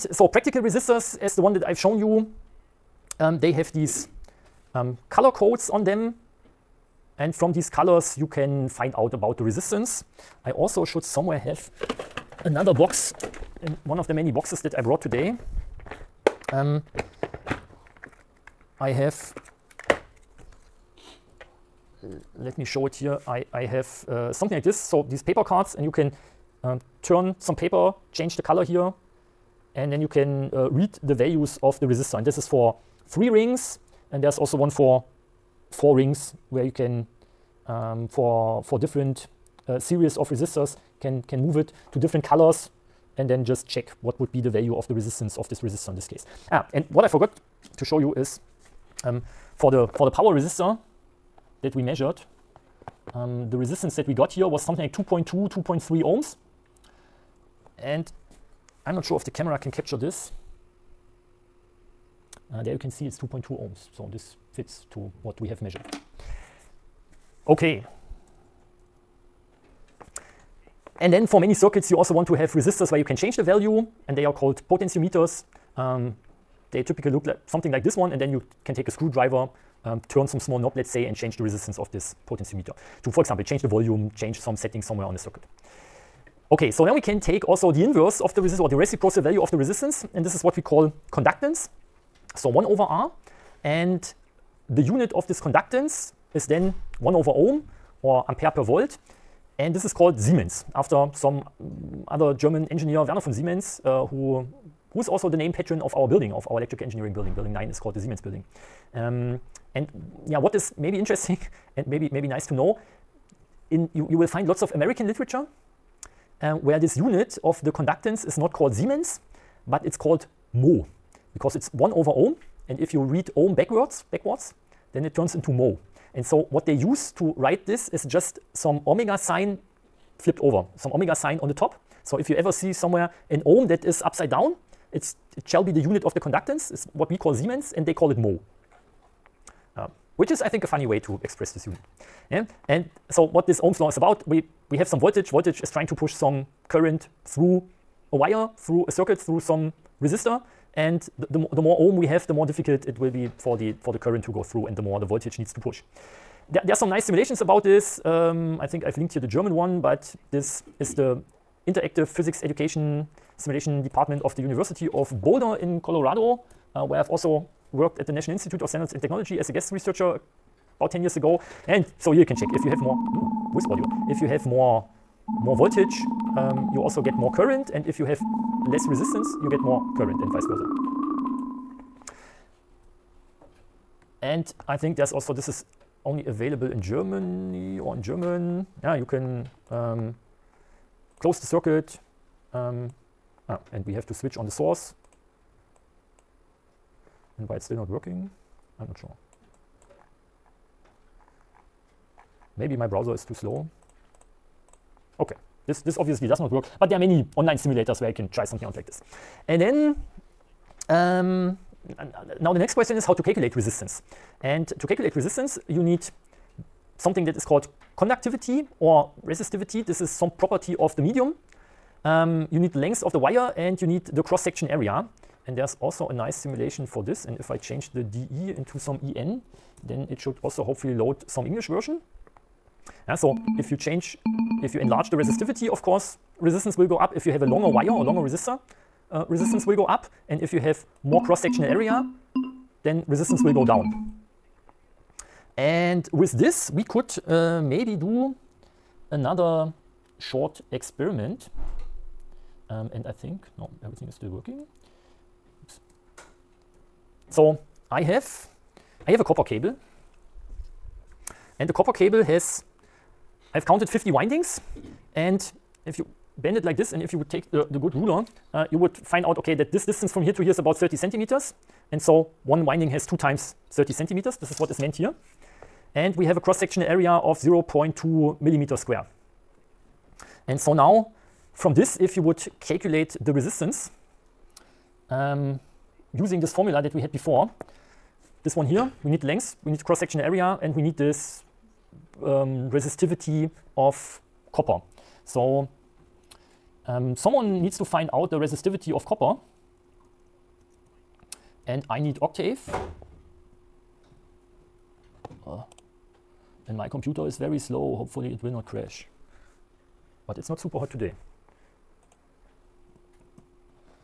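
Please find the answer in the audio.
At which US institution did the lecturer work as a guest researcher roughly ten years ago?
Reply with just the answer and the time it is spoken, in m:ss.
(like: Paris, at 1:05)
National Institute of Standards and Technology, at 2:48.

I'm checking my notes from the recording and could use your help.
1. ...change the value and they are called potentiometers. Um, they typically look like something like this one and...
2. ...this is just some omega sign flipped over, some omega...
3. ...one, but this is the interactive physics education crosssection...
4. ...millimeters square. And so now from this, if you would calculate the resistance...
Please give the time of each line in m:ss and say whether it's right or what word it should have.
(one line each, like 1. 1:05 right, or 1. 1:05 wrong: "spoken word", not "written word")
1. 1:13 right
2. 2:07 right
3. 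2:39 wrong: "simulation", not "crosssection"
4. 4:38 right.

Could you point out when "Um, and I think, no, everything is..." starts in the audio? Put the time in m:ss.
4:12.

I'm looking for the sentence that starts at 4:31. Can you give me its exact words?
And so one winding has two times 30 centimeters.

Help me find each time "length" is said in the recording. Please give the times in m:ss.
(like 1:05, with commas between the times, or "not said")
3:42, 4:49.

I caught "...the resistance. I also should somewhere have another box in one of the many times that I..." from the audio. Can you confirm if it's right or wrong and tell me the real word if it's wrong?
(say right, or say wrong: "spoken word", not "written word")
wrong: "boxes", not "times".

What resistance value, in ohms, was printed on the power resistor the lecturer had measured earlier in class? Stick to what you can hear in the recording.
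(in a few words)
2.2 ohms.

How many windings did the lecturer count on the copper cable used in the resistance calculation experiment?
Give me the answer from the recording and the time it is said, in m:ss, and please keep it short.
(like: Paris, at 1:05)
50, at 4:23.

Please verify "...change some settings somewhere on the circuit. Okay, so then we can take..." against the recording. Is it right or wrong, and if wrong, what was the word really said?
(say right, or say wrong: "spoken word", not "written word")
right.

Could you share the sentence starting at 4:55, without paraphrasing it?
So um, someone needs to find out the resistivity of copper.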